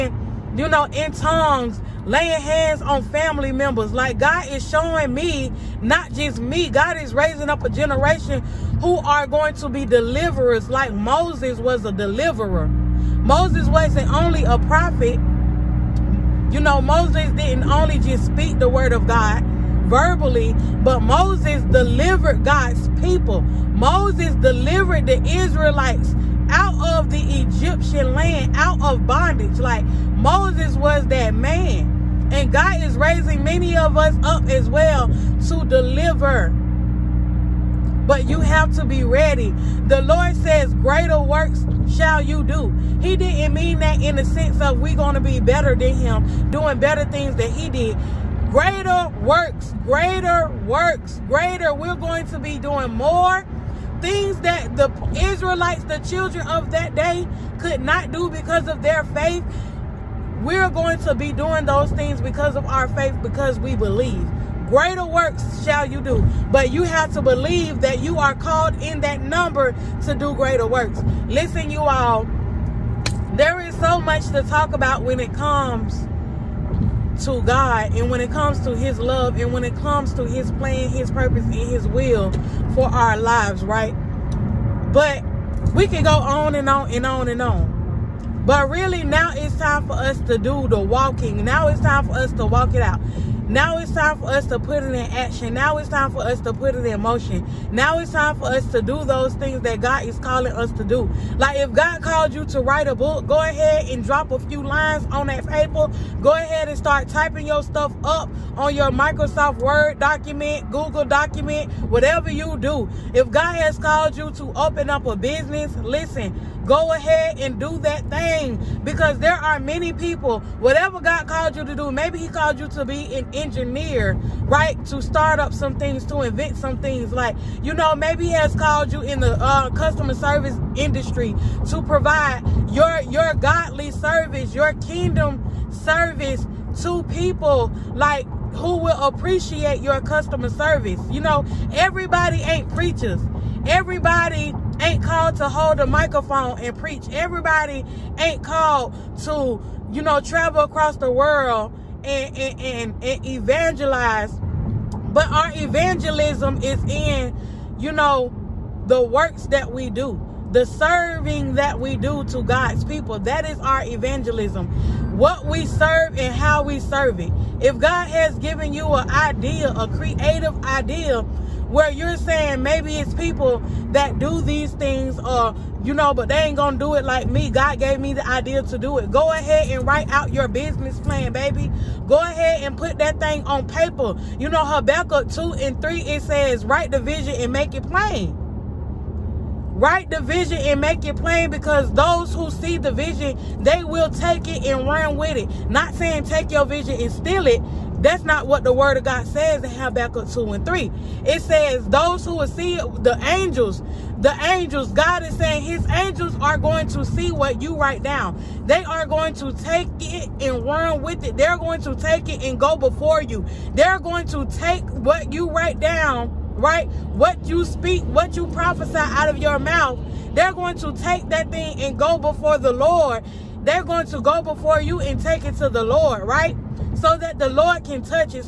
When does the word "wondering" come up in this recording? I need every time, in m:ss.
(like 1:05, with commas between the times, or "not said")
not said.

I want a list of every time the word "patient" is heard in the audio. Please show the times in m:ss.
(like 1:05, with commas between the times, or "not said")
not said.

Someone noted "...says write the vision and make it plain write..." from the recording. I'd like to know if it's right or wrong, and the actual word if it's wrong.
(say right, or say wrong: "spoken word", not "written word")
right.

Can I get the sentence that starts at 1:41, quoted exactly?
Like if God called you to write a book, go ahead and drop a few lines on that paper.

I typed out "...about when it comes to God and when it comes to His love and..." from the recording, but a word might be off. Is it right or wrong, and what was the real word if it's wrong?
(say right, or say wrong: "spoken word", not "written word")
right.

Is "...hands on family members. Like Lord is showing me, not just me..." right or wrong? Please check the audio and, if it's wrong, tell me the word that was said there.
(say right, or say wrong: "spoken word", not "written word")
wrong: "God", not "Lord".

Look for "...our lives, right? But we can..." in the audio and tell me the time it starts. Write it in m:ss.
1:22.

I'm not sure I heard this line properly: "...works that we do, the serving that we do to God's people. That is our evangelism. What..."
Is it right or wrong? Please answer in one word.
right.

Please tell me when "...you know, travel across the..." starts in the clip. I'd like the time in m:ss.
2:29.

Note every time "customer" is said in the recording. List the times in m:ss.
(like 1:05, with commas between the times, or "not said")
2:09, 2:20.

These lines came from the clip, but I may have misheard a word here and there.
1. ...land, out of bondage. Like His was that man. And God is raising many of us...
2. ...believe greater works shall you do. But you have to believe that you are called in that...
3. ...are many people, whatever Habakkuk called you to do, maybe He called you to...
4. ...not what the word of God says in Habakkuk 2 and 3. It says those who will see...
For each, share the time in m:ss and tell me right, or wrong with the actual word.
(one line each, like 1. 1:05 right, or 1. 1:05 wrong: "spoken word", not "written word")
1. 0:28 wrong: "Moses", not "His"
2. 1:03 right
3. 1:59 wrong: "God", not "Habakkuk"
4. 3:18 right.